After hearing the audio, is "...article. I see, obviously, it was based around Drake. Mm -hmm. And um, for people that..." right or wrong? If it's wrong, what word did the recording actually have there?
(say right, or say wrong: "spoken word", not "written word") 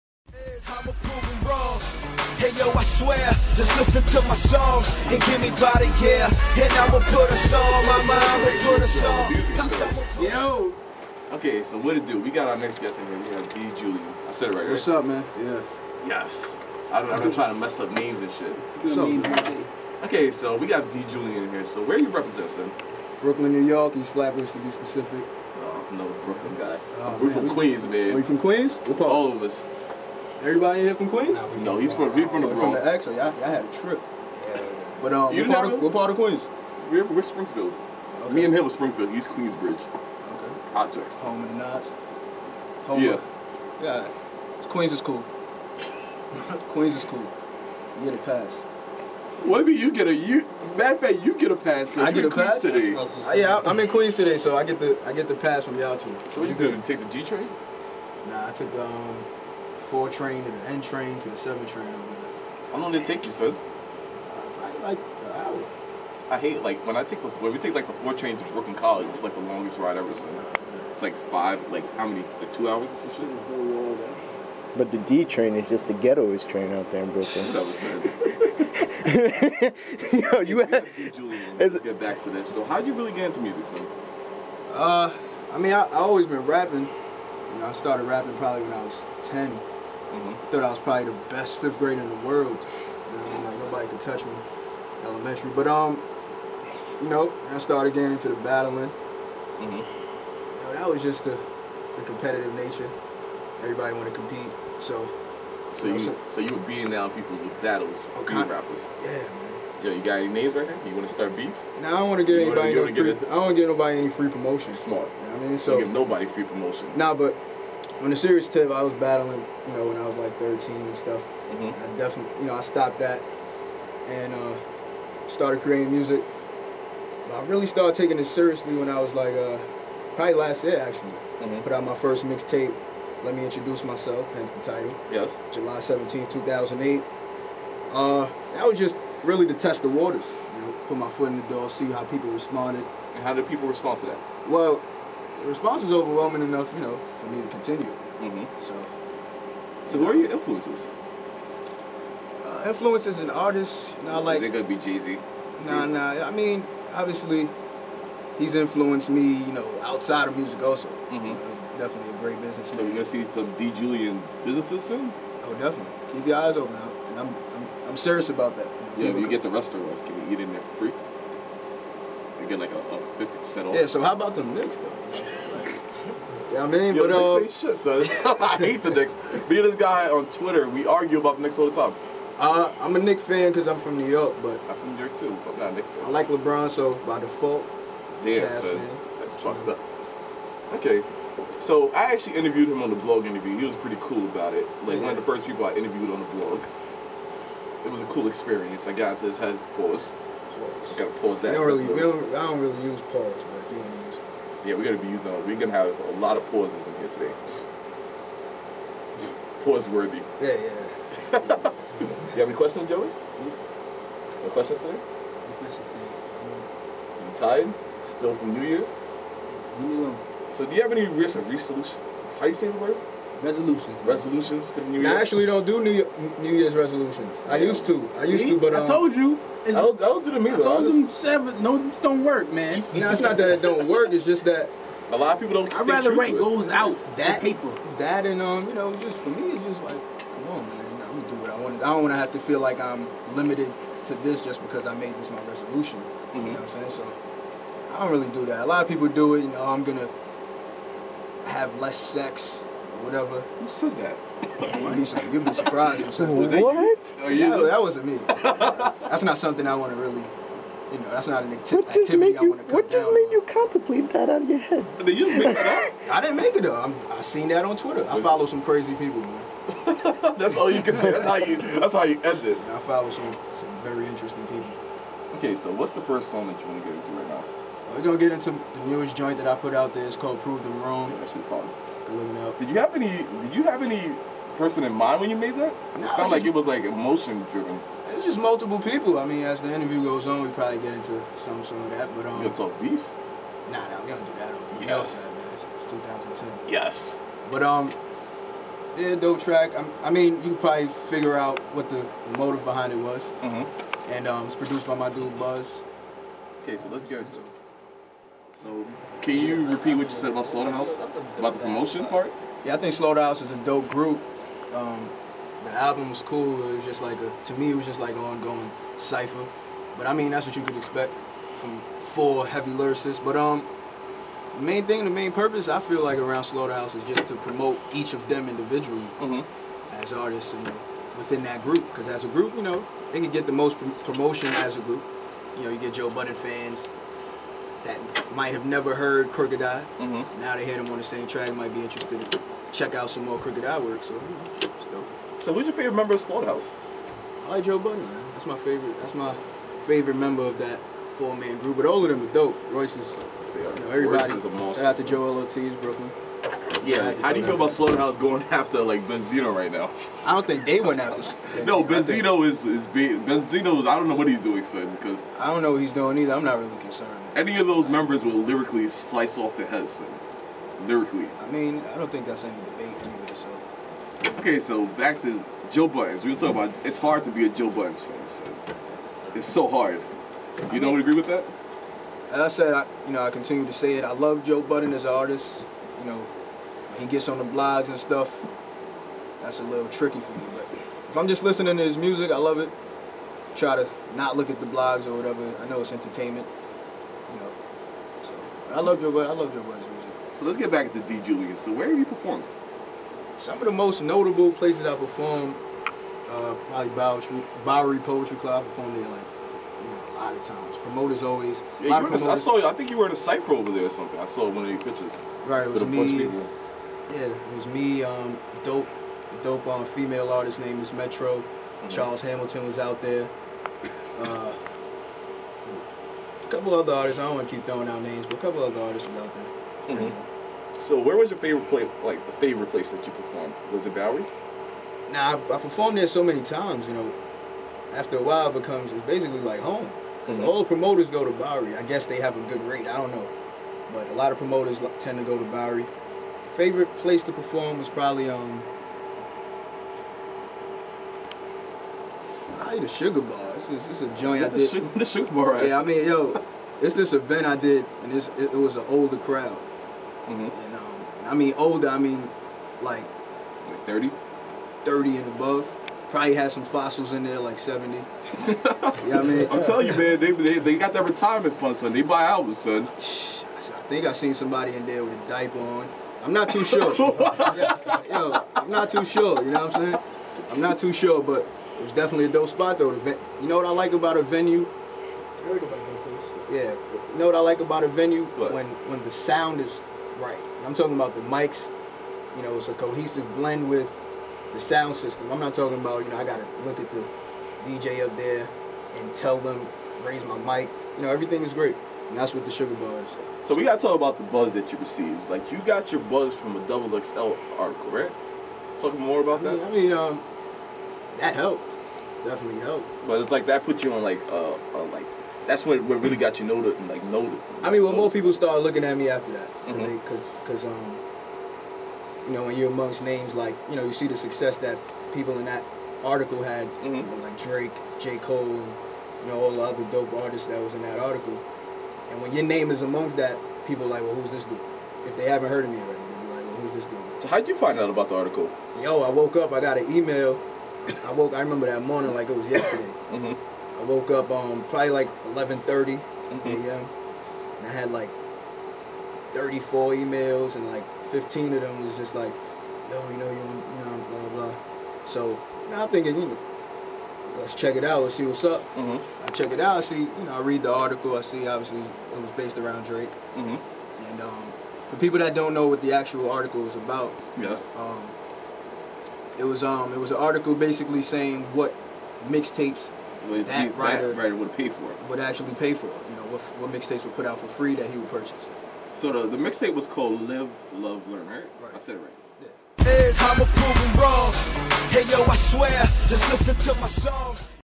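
right.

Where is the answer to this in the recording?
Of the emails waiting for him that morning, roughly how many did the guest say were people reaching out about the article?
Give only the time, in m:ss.
9:11.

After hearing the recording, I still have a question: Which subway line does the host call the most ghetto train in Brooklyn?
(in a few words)
D train.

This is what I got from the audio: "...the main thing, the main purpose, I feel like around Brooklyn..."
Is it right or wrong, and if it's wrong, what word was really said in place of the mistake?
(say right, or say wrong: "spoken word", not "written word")
wrong: "Slaughterhouse", not "Brooklyn".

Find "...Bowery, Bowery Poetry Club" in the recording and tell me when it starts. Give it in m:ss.
6:46.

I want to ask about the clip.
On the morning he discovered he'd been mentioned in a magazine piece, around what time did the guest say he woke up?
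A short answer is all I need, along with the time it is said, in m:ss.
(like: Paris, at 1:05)
11:30, at 9:05.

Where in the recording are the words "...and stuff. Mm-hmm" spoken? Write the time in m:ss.
2:00.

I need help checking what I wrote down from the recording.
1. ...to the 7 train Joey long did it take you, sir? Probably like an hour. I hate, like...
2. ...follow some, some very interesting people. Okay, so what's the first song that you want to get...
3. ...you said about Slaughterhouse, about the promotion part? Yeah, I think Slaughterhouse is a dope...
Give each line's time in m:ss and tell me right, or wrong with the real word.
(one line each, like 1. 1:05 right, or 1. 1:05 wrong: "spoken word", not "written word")
1. 1:01 wrong: "How", not "Joey"
2. 4:32 right
3. 5:10 right.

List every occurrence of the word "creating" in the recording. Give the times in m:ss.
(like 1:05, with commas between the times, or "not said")
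2:05.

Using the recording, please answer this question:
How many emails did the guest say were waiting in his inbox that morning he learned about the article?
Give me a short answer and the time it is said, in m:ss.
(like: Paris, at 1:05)
34, at 9:09.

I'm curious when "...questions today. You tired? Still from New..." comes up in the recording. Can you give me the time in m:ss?
3:35.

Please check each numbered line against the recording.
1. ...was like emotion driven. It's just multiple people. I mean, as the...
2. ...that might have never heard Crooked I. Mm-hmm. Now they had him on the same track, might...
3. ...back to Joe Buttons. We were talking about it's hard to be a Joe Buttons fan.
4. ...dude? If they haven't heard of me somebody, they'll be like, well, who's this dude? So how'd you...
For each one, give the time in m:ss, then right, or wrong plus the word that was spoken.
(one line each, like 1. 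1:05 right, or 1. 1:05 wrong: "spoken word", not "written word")
1. 4:46 right
2. 5:37 right
3. 6:14 right
4. 8:54 wrong: "already", not "somebody".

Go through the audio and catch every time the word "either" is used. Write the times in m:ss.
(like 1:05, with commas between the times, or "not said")
3:50, 6:06.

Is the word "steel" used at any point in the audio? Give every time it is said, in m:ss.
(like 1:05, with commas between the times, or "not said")
not said.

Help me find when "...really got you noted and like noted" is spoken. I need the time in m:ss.
8:36.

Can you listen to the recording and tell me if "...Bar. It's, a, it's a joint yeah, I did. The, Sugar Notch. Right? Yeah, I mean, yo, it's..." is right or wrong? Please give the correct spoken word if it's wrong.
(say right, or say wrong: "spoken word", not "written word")
wrong: "Bar", not "Notch".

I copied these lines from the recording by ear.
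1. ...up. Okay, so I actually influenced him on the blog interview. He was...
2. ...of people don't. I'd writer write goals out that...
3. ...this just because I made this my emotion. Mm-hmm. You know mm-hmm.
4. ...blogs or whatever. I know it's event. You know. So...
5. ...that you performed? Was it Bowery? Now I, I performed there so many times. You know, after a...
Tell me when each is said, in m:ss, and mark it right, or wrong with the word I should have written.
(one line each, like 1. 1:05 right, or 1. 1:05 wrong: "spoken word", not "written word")
1. 3:09 wrong: "interviewed", not "influenced"
2. 3:55 wrong: "rather", not "writer"
3. 4:04 wrong: "resolution", not "emotion"
4. 6:34 wrong: "entertainment", not "event"
5. 7:12 right.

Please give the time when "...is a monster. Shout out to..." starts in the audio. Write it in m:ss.
5:54.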